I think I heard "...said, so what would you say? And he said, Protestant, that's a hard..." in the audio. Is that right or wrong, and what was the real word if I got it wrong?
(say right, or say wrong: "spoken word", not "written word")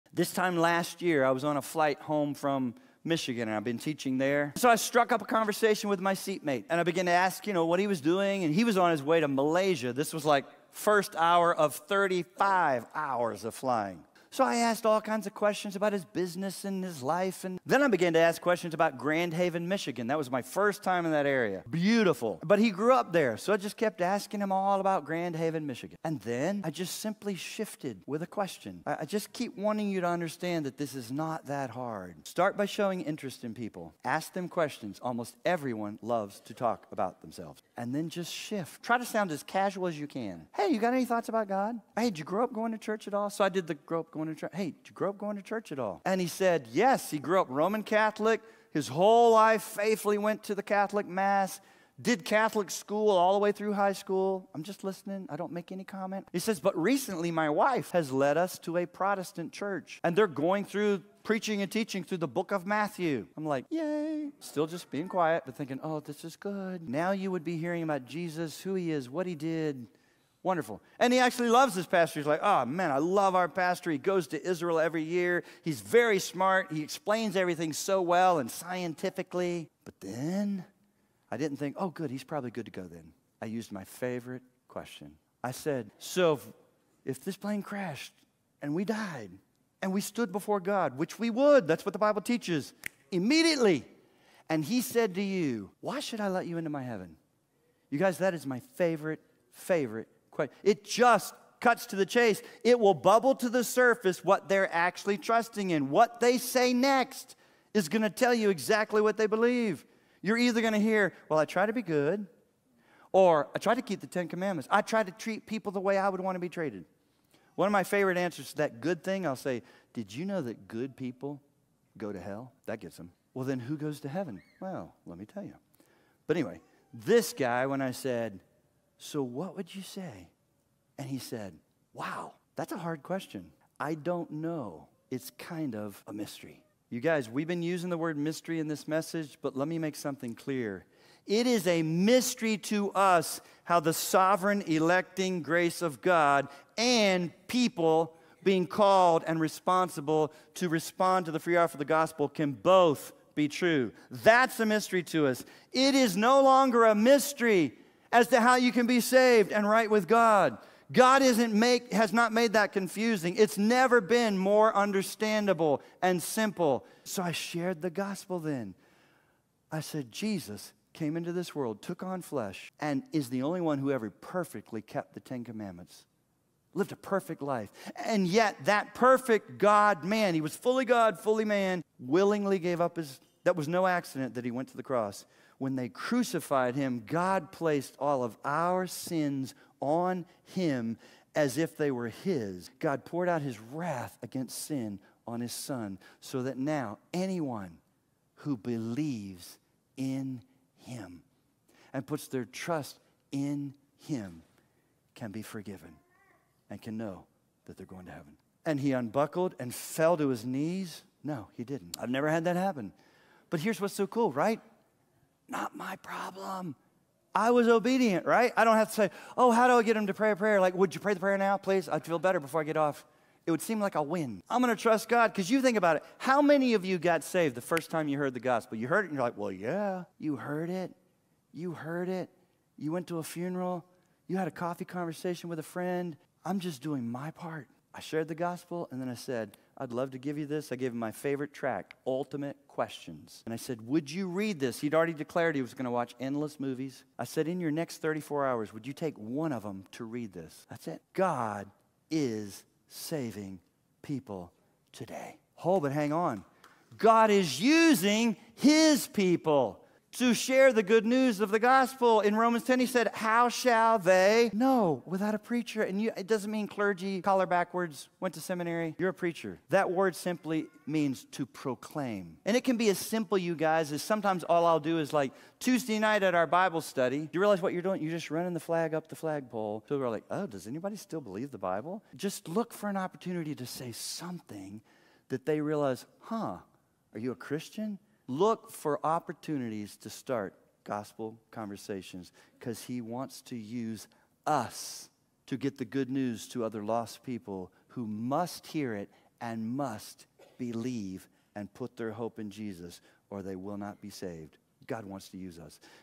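wrong: "Wow", not "Protestant".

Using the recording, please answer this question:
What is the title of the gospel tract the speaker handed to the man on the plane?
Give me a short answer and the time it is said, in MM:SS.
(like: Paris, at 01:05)
Ultimate Questions, at 04:02.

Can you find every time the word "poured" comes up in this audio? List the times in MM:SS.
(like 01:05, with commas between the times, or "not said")
03:13.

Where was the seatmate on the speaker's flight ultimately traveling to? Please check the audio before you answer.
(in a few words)
Malaysia.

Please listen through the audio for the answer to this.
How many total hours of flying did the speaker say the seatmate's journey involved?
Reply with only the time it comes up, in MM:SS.
00:11.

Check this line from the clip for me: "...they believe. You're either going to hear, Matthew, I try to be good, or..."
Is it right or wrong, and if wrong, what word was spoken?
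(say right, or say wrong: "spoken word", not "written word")
wrong: "Well", not "Matthew".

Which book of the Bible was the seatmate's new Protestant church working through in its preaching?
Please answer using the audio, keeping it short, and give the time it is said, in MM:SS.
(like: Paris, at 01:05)
Matthew, at 01:02.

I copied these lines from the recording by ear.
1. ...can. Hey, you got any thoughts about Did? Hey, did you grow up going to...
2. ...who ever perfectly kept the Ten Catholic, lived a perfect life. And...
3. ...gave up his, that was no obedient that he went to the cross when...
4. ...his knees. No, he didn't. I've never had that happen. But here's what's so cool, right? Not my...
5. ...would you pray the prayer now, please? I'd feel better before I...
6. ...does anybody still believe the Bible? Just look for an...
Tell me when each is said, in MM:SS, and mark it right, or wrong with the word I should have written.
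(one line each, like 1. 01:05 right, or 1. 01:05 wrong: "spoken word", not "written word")
1. 00:40 wrong: "God", not "Did"
2. 02:53 wrong: "Commandments", not "Catholic"
3. 03:02 wrong: "accident", not "obedient"
4. 03:30 right
5. 03:40 right
6. 04:40 right.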